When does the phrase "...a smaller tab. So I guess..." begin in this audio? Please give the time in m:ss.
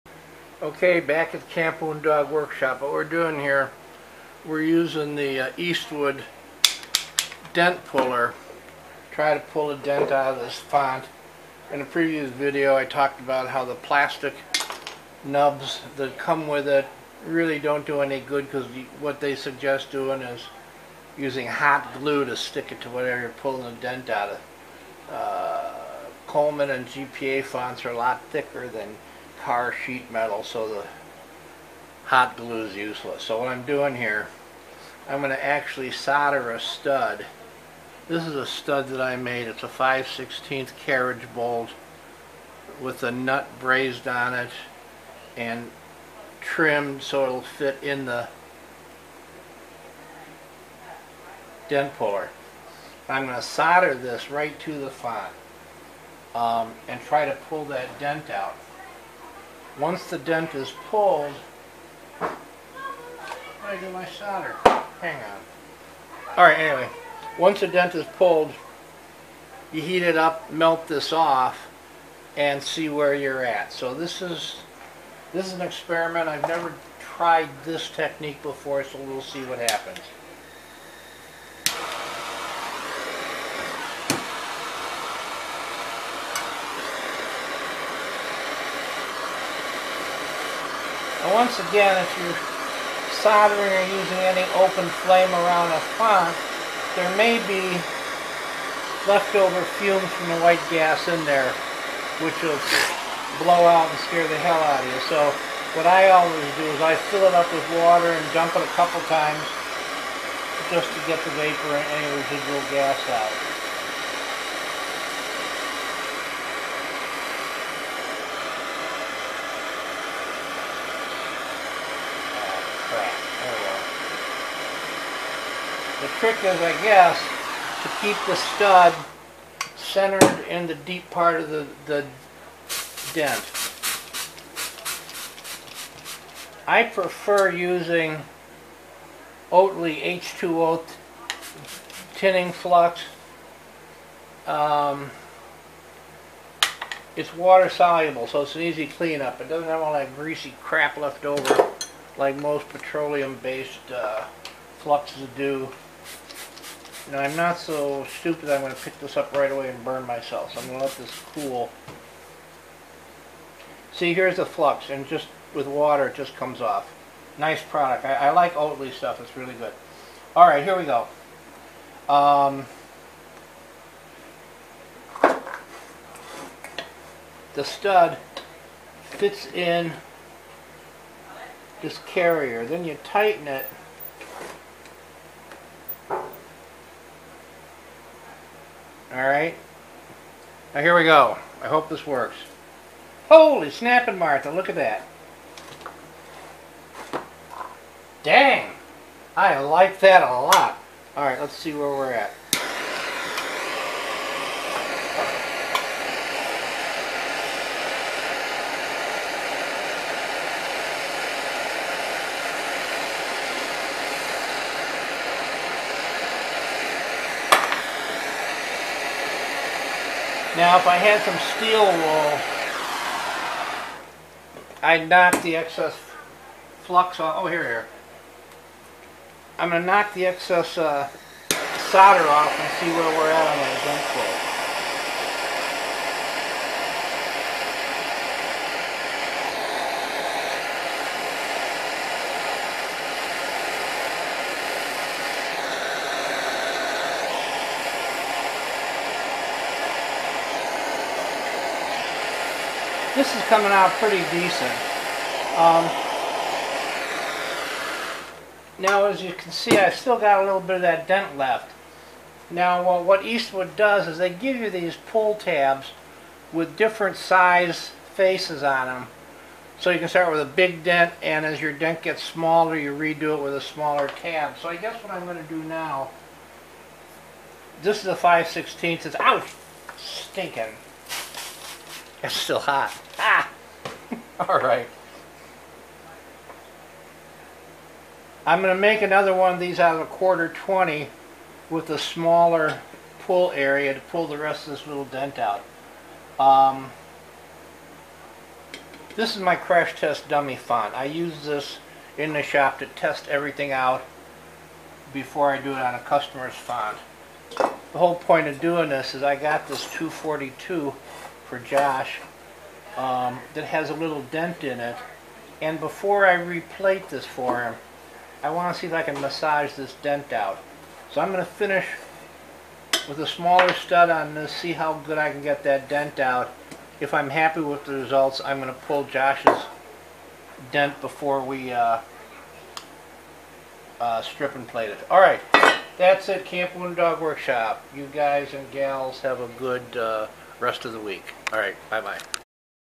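4:33.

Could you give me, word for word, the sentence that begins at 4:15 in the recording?
Um, now, as you can see, I still got a little bit of that dent left.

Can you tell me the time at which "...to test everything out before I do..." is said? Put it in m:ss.
5:02.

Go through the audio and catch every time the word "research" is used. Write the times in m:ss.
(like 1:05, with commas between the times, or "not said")
not said.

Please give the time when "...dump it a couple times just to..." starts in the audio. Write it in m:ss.
1:48.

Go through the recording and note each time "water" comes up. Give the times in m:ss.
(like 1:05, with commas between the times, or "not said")
1:47, 2:27, 2:45.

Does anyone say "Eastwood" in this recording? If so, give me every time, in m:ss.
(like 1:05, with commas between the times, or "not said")
0:05, 4:23.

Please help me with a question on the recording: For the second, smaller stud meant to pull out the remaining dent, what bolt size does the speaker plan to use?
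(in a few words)
1/4-20.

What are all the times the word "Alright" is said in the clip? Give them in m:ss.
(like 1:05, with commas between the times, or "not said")
1:06, 3:09, 3:21.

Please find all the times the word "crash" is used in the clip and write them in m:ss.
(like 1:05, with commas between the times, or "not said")
4:59.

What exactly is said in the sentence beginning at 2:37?
You know, I'm not so stupid I'm going to pick this up right away and burn myself.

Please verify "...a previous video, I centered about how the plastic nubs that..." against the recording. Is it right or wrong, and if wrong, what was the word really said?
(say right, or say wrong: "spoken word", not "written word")
wrong: "talked", not "centered".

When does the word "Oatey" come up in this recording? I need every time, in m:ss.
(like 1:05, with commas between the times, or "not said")
2:19, 2:48.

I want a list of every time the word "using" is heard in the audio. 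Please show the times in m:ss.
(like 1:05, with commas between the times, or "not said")
0:04, 0:21, 1:33, 2:17.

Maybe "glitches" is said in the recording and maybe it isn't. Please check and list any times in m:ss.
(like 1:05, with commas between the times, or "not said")
not said.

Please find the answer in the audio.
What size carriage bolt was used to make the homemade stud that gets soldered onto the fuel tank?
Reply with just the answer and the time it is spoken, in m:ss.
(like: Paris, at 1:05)
5/16, at 0:39.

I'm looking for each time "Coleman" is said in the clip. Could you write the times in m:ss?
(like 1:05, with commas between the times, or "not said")
0:26.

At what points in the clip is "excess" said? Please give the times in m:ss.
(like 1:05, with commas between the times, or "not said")
3:45, 3:50.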